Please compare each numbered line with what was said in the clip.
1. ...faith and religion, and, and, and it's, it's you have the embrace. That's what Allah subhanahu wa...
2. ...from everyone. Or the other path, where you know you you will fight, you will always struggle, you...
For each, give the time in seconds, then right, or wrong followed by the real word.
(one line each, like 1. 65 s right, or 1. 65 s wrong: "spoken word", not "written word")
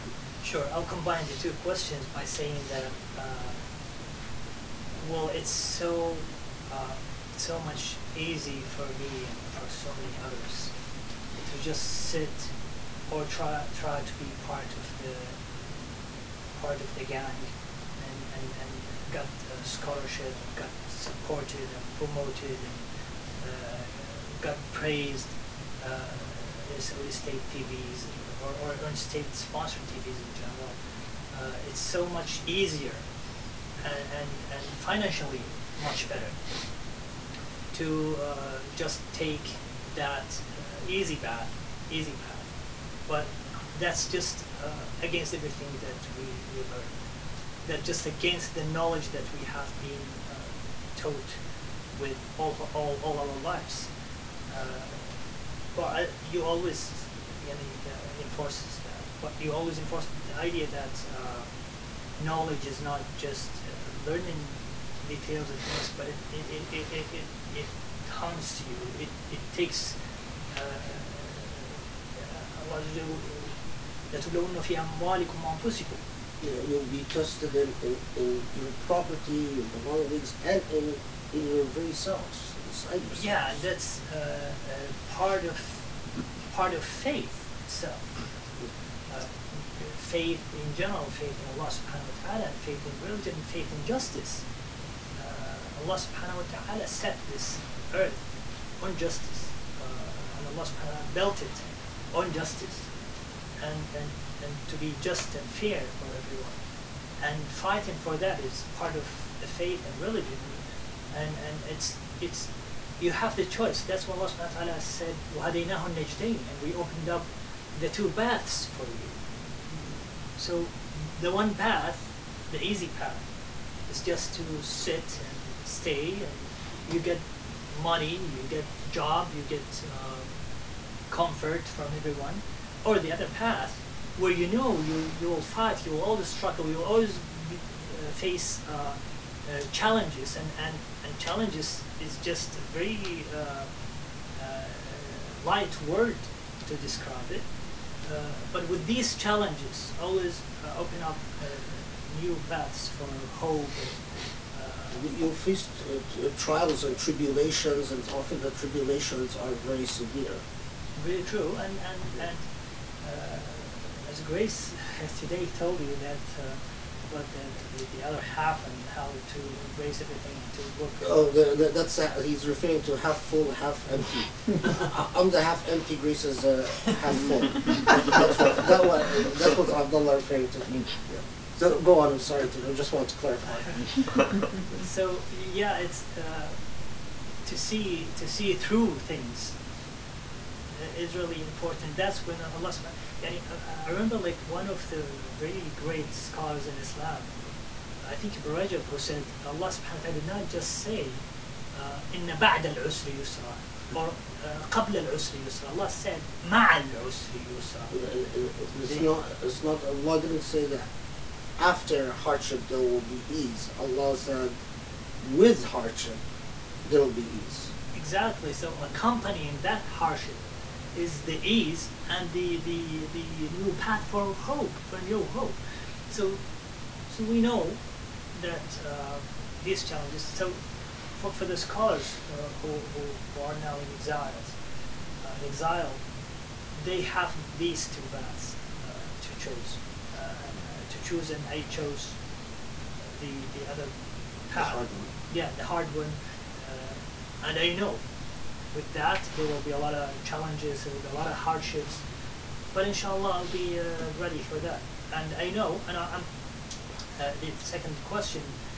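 1. 109 s wrong: "choice", not "embrace"
2. 131 s right.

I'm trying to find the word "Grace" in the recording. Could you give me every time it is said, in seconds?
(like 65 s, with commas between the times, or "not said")
164 s, 175 s.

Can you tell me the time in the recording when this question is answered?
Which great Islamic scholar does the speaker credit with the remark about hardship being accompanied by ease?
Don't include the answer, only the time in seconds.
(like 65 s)
198 s.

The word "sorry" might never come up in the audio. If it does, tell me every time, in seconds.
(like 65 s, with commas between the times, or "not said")
182 s.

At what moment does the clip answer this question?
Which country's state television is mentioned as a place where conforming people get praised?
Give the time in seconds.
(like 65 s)
26 s.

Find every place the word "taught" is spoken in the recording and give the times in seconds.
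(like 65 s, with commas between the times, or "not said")
50 s.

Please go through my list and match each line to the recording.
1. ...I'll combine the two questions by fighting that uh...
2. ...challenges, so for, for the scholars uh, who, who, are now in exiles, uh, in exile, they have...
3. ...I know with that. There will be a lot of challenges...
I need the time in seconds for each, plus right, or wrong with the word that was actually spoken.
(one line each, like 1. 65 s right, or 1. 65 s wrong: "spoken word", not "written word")
1. 0 s wrong: "saying", not "fighting"
2. 229 s right
3. 247 s right.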